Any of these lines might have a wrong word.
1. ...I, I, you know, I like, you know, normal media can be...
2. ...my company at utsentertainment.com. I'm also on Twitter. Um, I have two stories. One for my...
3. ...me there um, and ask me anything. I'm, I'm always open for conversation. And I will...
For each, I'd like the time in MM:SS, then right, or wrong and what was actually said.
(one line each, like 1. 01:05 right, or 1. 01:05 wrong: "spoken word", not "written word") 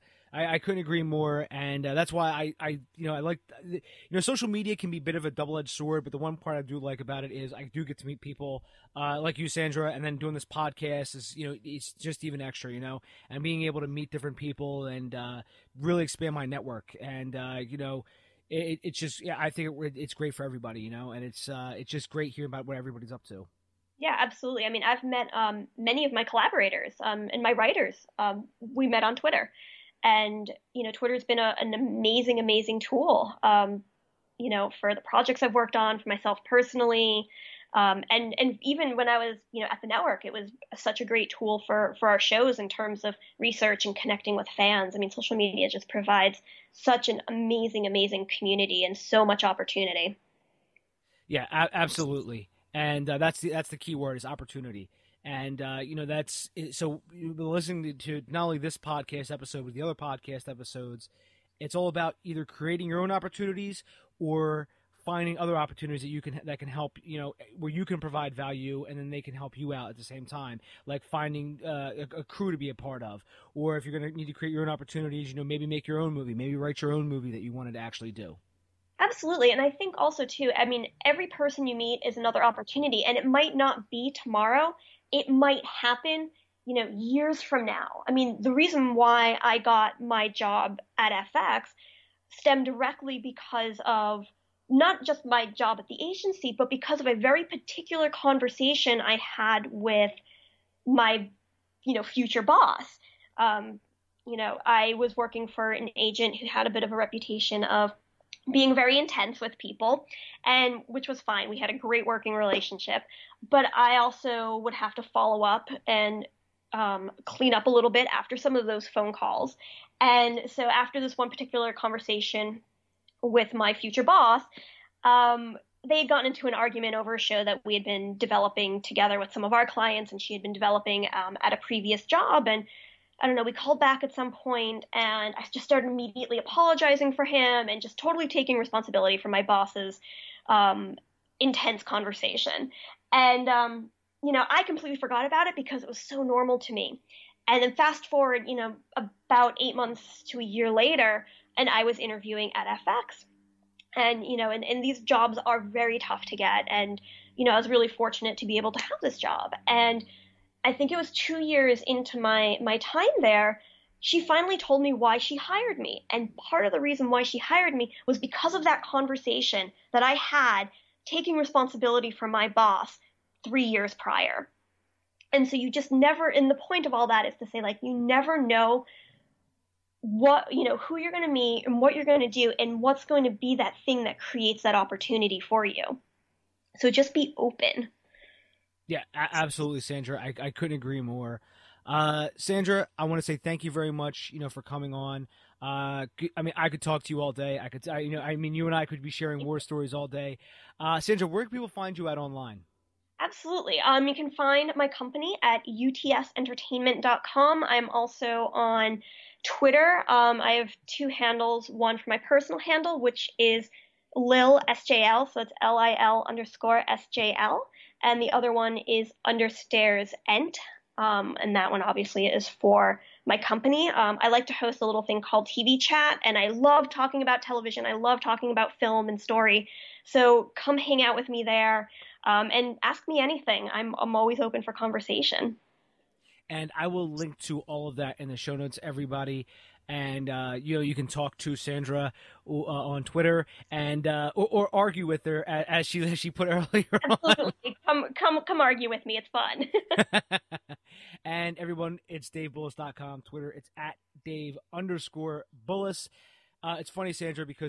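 1. 00:02 wrong: "social", not "normal"
2. 03:24 wrong: "handles", not "stories"
3. 03:51 right.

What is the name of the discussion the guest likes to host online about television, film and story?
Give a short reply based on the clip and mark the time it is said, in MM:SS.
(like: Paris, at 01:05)
TV Chat, at 03:45.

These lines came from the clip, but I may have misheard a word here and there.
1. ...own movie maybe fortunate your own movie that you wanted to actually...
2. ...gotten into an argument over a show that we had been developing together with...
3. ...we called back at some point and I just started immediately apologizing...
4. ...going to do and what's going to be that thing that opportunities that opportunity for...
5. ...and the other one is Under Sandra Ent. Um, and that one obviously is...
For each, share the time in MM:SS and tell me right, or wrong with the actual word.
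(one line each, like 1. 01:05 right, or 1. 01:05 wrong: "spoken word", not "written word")
1. 01:15 wrong: "write", not "fortunate"
2. 02:06 right
3. 02:13 right
4. 03:02 wrong: "creates", not "opportunities"
5. 03:38 wrong: "Stairs", not "Sandra".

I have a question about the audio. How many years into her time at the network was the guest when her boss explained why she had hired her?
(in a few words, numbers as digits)
2.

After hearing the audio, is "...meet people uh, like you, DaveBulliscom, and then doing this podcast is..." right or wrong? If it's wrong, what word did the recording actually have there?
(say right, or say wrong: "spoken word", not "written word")
wrong: "Sandra", not "DaveBulliscom".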